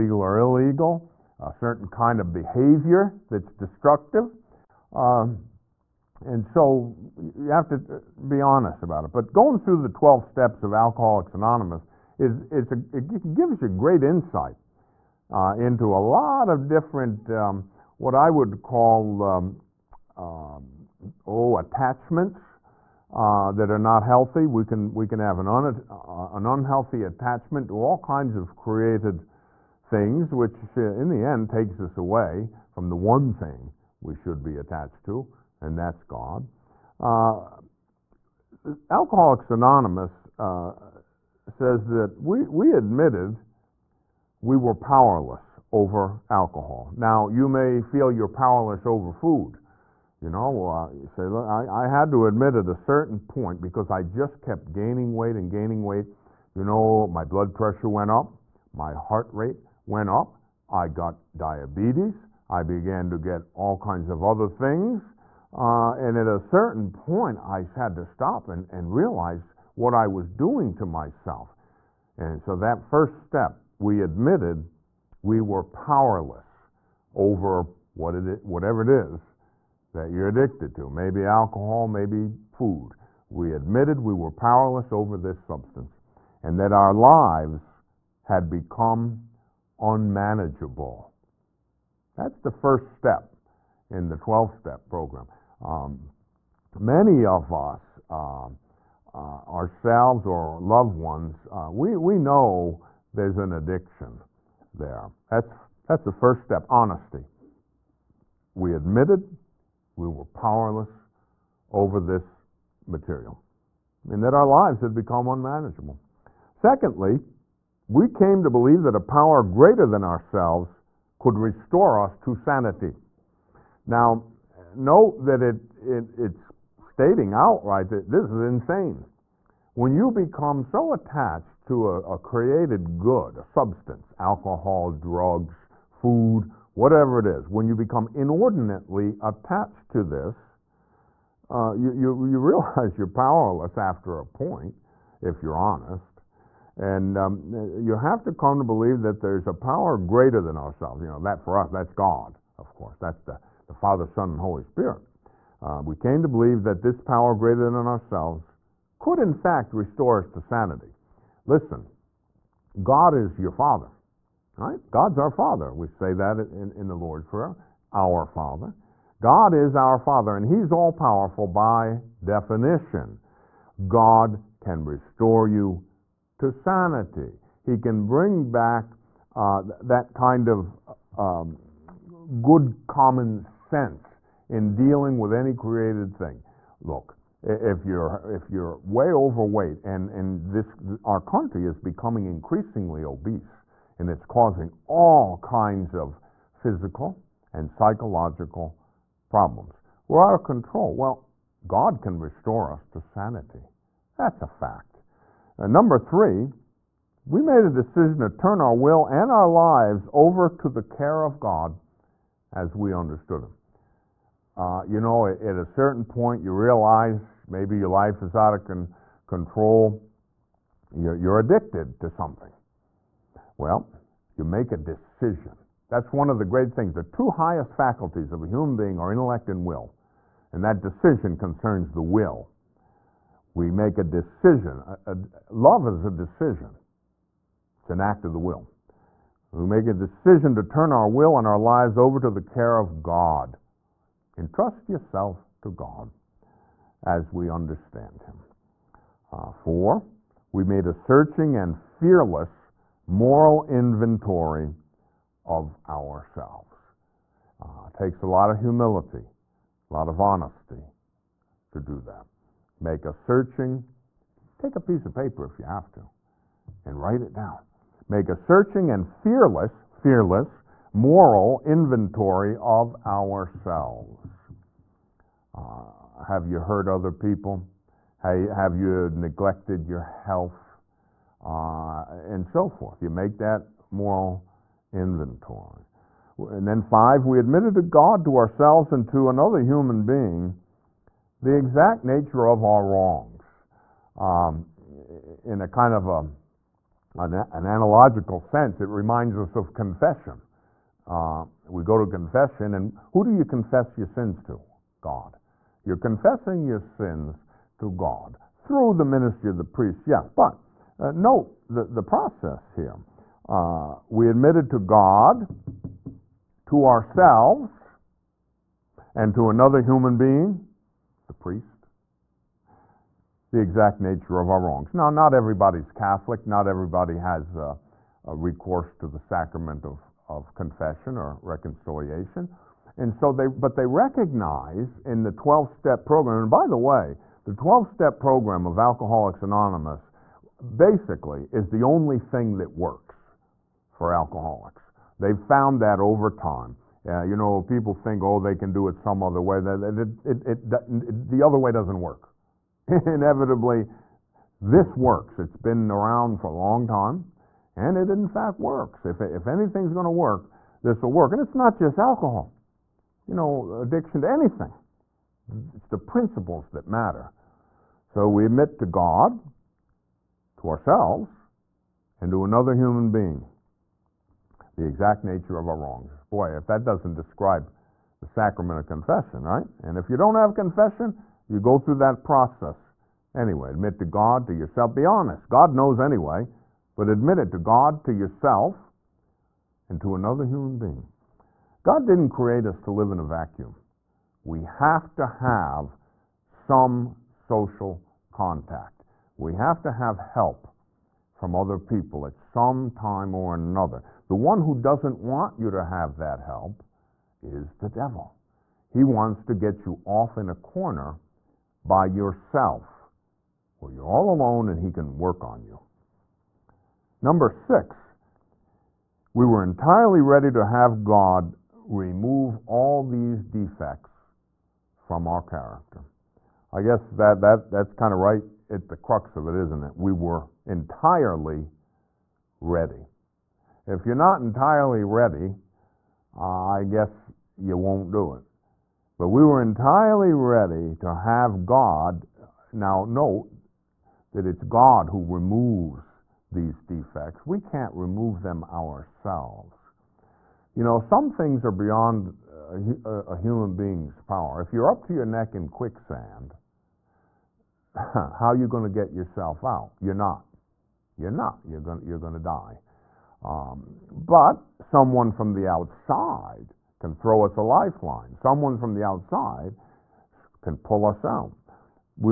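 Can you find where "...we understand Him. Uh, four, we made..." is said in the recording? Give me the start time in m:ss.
4:07.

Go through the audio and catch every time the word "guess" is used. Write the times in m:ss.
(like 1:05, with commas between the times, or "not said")
7:06, 7:16.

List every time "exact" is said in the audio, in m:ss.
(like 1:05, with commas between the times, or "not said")
4:51, 5:23, 6:14.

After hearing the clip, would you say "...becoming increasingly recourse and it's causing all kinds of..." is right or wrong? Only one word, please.
wrong.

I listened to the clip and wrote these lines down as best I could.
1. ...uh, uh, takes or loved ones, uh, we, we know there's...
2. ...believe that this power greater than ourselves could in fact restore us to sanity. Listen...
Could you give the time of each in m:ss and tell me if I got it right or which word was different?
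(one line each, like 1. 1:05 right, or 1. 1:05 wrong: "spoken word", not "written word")
1. 1:38 wrong: "ourselves", not "takes"
2. 2:36 right.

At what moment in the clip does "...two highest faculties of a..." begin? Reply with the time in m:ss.
3:47.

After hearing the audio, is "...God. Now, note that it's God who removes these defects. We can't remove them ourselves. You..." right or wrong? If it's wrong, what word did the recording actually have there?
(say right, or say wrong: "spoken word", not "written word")
right.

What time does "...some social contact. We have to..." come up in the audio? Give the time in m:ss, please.
6:36.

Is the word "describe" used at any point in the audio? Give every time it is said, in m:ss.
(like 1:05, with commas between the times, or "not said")
6:17.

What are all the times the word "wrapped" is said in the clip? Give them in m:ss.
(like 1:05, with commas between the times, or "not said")
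not said.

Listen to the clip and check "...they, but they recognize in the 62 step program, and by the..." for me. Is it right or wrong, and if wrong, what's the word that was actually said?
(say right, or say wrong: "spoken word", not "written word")
wrong: "12", not "62".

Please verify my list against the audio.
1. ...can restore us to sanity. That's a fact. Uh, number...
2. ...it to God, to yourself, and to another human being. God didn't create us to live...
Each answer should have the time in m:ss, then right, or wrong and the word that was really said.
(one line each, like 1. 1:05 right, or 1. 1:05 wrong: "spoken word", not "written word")
1. 3:22 right
2. 6:27 right.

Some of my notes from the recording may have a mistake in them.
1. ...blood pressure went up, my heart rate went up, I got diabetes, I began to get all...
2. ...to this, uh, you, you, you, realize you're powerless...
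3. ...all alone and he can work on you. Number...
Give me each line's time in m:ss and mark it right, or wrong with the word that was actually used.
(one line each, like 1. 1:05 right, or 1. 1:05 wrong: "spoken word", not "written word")
1. 0:57 right
2. 2:19 right
3. 6:54 right.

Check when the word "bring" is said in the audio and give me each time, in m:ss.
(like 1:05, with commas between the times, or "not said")
2:58.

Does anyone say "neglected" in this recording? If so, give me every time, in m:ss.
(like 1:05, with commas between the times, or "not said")
4:39.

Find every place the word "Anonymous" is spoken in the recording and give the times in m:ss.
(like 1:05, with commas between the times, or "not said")
0:11, 0:39, 5:39.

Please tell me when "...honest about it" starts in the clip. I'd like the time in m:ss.
0:08.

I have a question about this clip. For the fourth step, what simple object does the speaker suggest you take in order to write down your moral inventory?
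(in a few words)
a piece of paper.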